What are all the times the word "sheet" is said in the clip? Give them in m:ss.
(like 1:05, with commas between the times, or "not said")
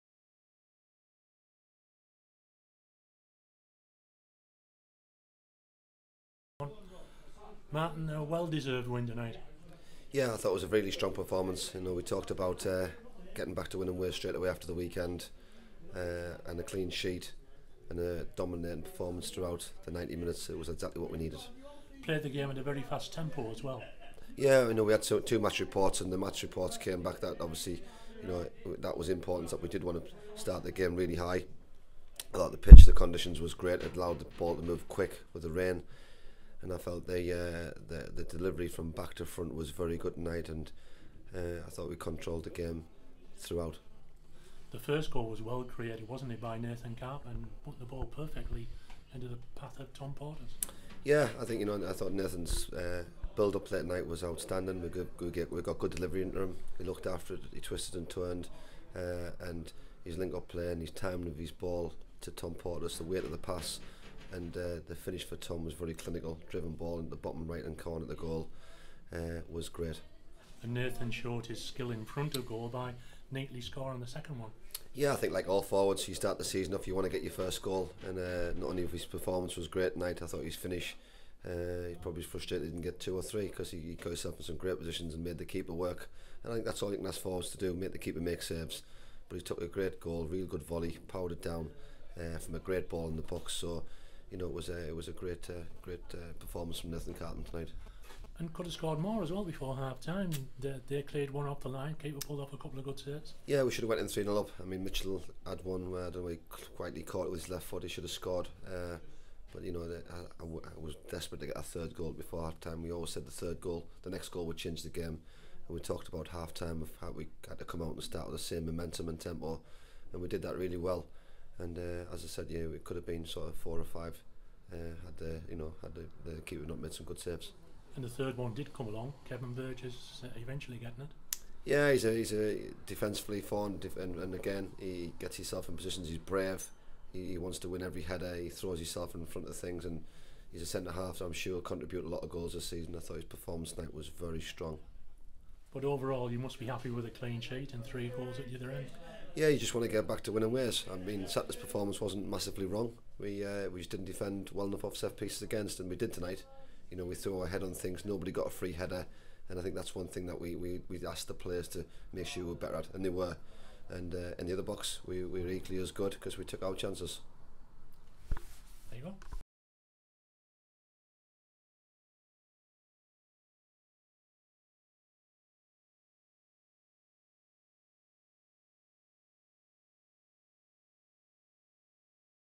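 0:16, 2:27.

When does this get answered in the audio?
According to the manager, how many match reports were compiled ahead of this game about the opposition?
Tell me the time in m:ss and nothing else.
0:25.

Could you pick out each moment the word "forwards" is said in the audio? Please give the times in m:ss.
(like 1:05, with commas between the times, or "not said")
1:15, 1:27.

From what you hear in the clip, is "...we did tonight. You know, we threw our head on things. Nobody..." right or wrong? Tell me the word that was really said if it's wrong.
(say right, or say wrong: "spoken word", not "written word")
right.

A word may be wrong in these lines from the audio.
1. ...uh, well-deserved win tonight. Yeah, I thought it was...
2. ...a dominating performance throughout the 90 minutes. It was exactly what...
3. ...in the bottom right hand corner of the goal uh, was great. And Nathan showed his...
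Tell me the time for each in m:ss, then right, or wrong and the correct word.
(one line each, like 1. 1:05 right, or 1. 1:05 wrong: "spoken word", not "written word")
1. 0:08 right
2. 0:17 right
3. 1:06 right.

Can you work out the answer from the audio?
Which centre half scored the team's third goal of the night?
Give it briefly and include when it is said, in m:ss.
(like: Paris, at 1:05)
Kevin Burgess, at 2:09.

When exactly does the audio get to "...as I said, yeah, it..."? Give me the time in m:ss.
2:02.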